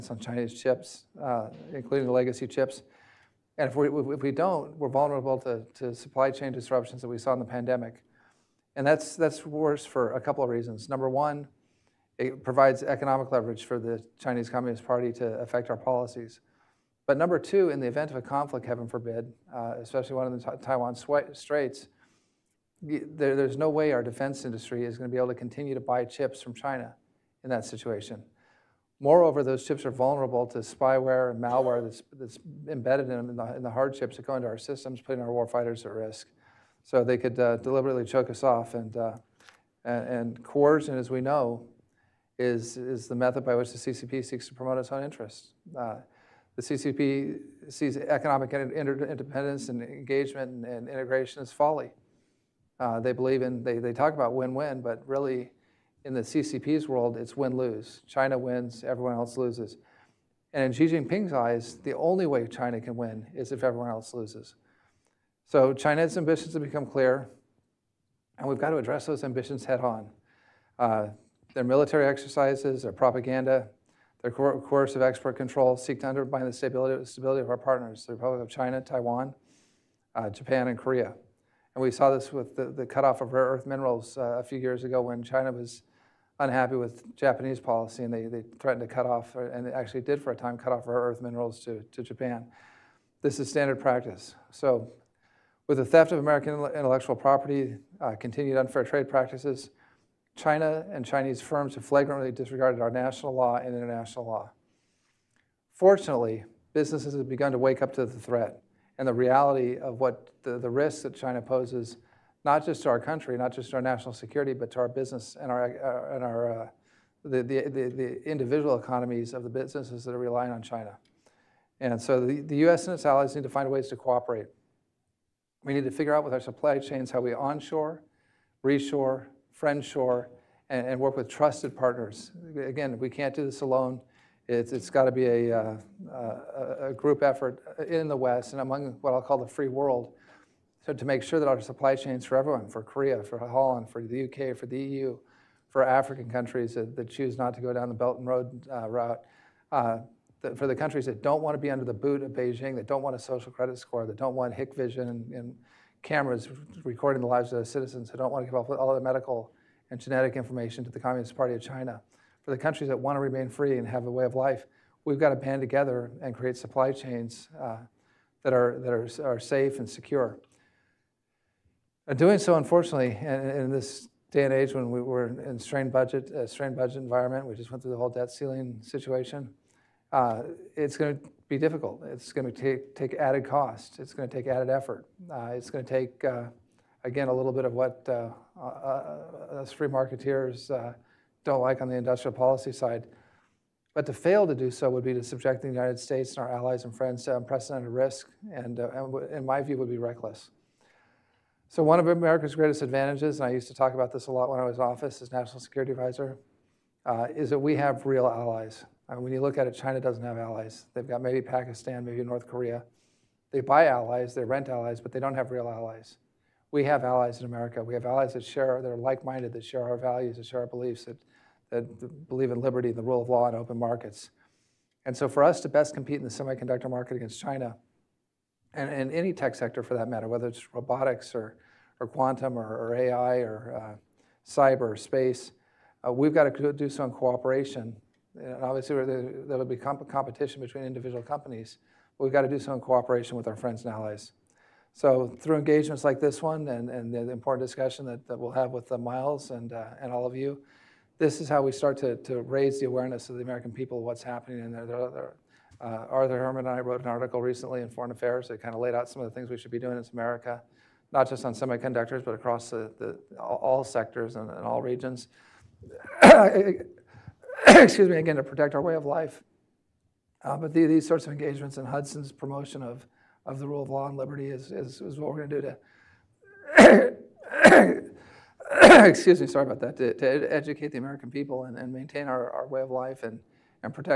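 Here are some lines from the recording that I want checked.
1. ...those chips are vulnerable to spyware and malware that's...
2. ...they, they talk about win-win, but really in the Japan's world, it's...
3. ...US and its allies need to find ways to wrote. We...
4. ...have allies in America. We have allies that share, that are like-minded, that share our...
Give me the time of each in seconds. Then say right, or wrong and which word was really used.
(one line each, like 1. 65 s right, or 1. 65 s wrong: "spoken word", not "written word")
1. 29 s right
2. 53 s wrong: "CCP", not "Japan"
3. 122 s wrong: "cooperate", not "wrote"
4. 216 s right.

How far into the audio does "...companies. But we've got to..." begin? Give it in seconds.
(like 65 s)
241 s.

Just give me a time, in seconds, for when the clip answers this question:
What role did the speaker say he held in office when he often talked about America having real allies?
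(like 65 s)
205 s.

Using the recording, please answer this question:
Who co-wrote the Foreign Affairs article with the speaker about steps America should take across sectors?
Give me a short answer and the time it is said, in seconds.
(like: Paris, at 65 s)
Arthur Herman, at 256 s.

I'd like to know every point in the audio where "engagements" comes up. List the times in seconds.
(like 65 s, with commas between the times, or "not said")
49 s, 245 s, 271 s.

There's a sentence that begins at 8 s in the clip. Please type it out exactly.
And that's, that's worse for a couple of reasons.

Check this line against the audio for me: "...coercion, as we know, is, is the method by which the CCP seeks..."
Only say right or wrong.
right.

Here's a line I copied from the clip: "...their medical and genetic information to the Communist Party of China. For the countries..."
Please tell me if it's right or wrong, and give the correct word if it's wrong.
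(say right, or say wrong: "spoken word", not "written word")
right.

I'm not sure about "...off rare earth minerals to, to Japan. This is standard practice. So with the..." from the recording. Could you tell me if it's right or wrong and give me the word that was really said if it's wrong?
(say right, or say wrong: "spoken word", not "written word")
right.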